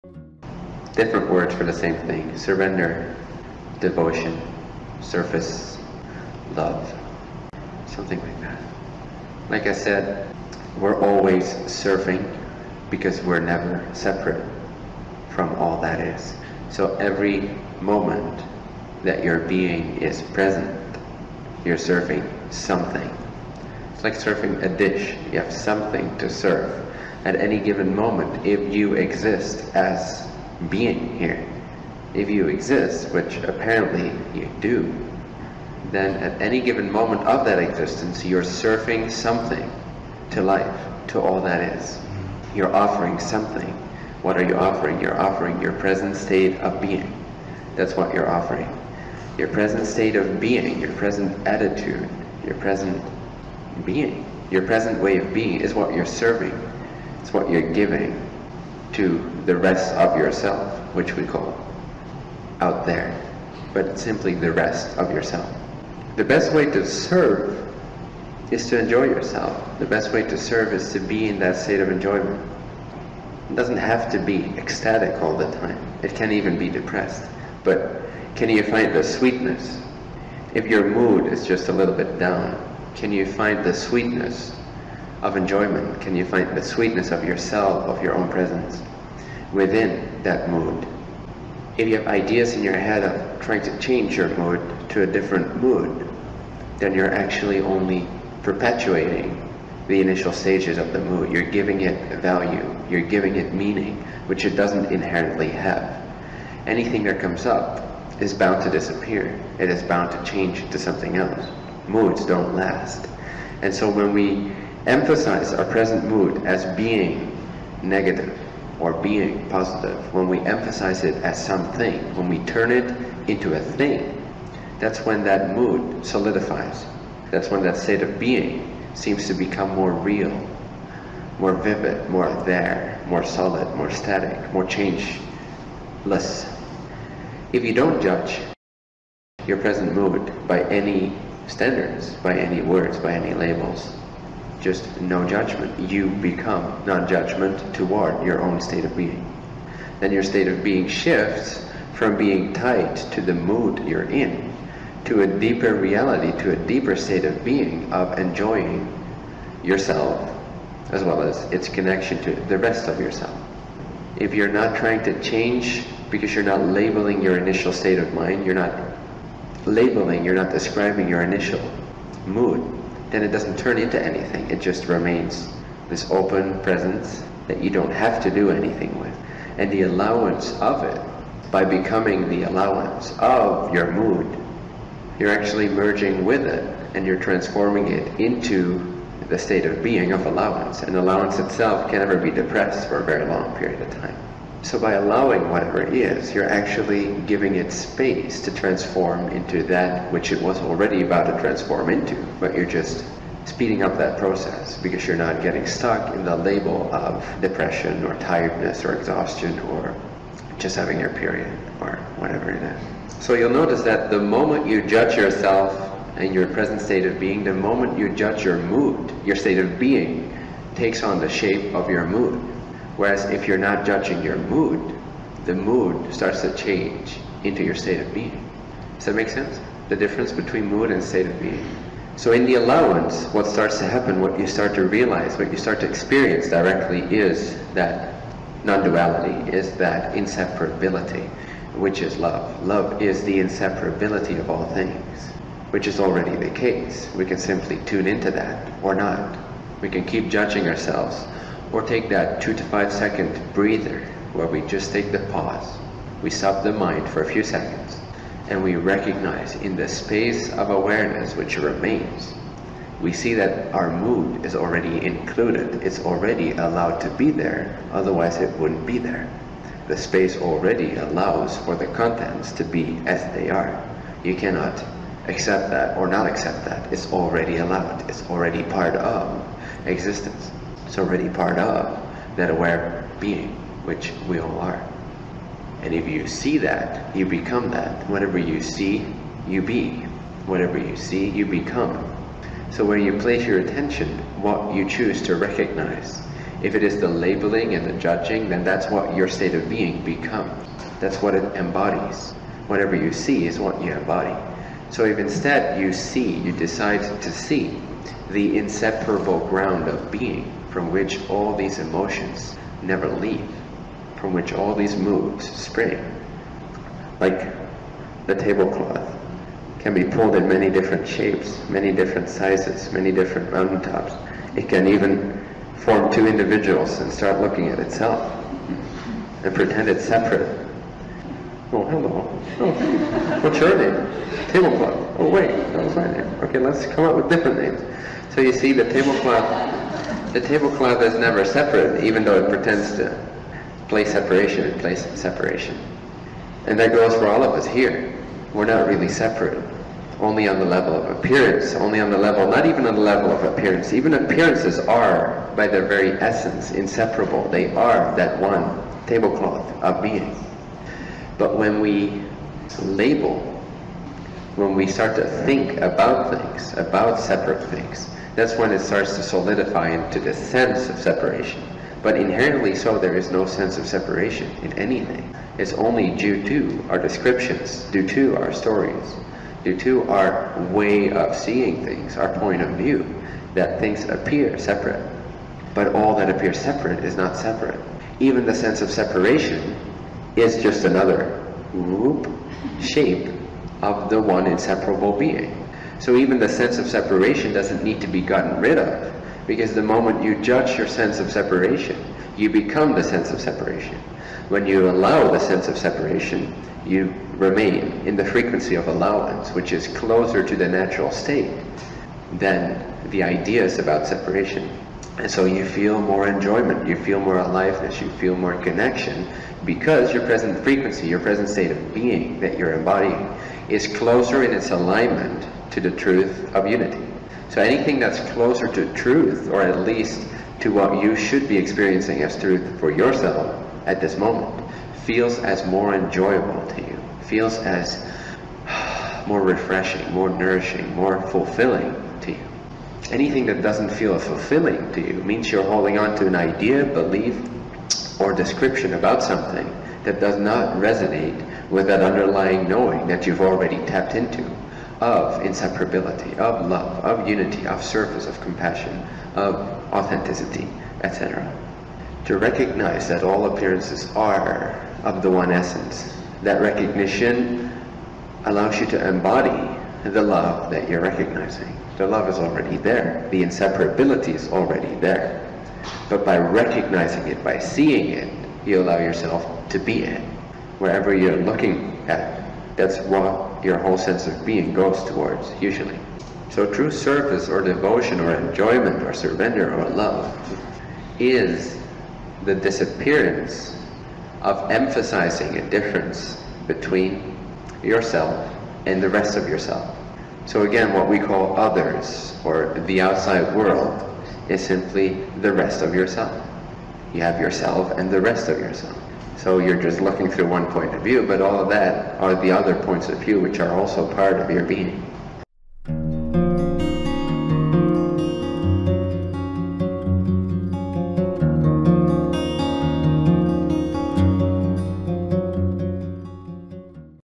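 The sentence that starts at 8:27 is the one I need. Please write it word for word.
You have yourself and the rest of yourself.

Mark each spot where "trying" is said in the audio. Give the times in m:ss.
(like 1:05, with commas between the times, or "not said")
1:33, 2:44.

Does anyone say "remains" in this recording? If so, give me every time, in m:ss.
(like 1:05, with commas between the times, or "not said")
2:54, 4:21, 6:47.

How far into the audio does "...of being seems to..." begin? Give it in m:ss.
2:08.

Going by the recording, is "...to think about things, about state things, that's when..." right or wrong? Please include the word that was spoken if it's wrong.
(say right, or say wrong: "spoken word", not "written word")
wrong: "separate", not "state".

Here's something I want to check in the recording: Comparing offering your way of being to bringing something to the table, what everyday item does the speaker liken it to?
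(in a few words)
A dish.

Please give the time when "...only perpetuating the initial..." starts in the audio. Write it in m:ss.
1:37.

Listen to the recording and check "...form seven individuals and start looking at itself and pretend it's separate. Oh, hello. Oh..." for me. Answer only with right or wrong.
wrong.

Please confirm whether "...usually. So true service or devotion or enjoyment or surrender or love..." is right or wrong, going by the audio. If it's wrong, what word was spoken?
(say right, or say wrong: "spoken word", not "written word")
right.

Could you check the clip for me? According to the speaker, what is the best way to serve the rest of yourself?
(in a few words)
Enjoy yourself.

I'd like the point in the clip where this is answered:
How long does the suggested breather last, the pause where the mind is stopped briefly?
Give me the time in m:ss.
4:12.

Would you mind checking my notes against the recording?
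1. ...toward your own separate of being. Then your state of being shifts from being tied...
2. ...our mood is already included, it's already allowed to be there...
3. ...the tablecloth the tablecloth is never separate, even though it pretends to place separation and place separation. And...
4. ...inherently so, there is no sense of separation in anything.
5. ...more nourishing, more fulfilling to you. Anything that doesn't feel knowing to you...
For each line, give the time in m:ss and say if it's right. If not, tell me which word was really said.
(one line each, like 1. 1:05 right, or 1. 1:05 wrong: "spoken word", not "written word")
1. 2:27 wrong: "state", not "separate"
2. 4:23 right
3. 5:38 right
4. 6:12 right
5. 7:20 wrong: "fulfilling", not "knowing".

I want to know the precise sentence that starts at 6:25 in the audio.
But all that appears separate is not separate.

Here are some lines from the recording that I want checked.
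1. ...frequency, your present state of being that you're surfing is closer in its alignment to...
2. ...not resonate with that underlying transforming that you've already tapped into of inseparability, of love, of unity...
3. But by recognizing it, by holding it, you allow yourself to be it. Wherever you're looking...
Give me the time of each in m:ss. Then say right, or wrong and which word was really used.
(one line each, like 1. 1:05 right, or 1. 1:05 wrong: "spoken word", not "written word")
1. 7:00 wrong: "embodying", not "surfing"
2. 7:30 wrong: "knowing", not "transforming"
3. 7:56 wrong: "seeing", not "holding".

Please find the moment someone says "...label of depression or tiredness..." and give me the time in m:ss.
3:26.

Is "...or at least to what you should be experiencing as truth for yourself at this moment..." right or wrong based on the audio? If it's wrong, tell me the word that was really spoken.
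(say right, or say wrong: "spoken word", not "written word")
right.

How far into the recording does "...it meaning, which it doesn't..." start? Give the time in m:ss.
1:43.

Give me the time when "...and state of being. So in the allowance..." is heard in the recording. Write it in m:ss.
3:50.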